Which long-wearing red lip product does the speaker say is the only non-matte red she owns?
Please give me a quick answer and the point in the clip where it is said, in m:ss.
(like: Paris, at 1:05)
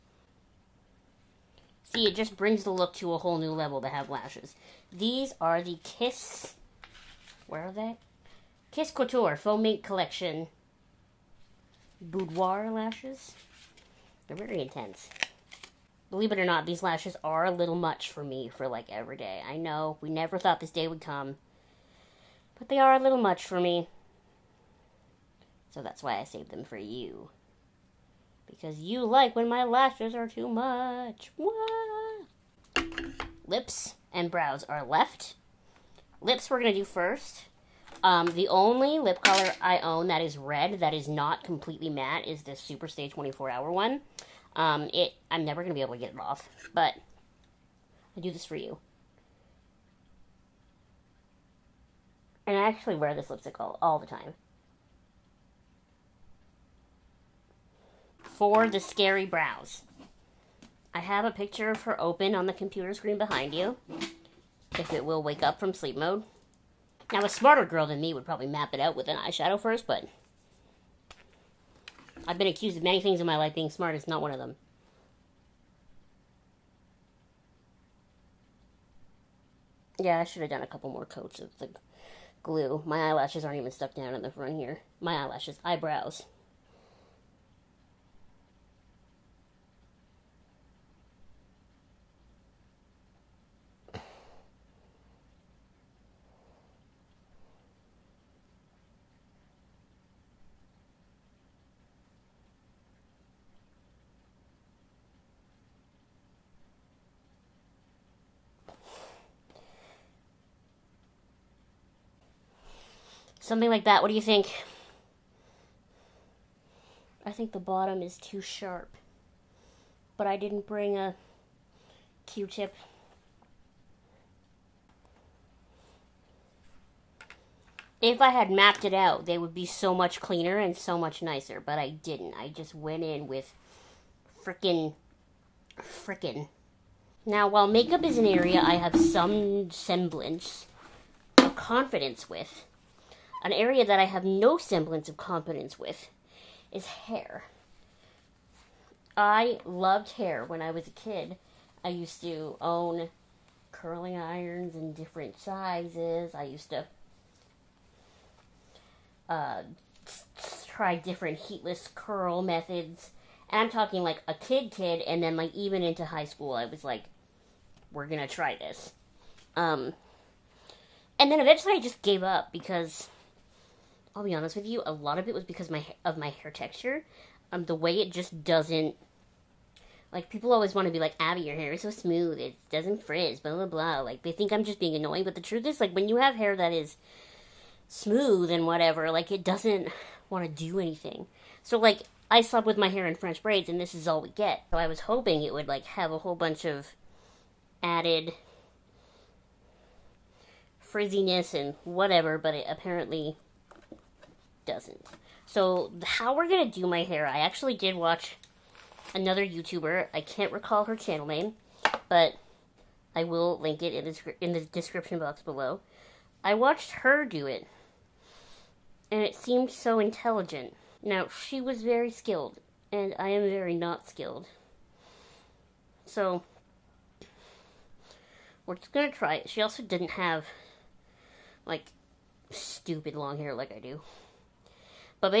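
Superstay 24 Hour, at 0:42.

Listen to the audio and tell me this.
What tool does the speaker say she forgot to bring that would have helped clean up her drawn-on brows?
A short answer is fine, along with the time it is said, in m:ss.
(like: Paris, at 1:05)
Q-tip, at 2:02.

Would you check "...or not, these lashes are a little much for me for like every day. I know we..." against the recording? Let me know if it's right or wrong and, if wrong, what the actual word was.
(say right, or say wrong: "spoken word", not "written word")
right.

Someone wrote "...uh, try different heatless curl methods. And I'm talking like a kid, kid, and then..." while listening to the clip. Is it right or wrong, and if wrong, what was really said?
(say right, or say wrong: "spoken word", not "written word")
right.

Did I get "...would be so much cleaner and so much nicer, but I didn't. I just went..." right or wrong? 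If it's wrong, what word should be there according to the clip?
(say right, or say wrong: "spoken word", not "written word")
right.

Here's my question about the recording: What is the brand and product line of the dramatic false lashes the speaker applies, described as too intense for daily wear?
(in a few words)
Kiss Couture Faux Mink Collection Boudoir.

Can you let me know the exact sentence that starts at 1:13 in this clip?
Being smart is not one of them.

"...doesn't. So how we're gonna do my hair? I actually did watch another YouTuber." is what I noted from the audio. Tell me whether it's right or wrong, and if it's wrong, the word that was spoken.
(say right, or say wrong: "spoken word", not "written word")
right.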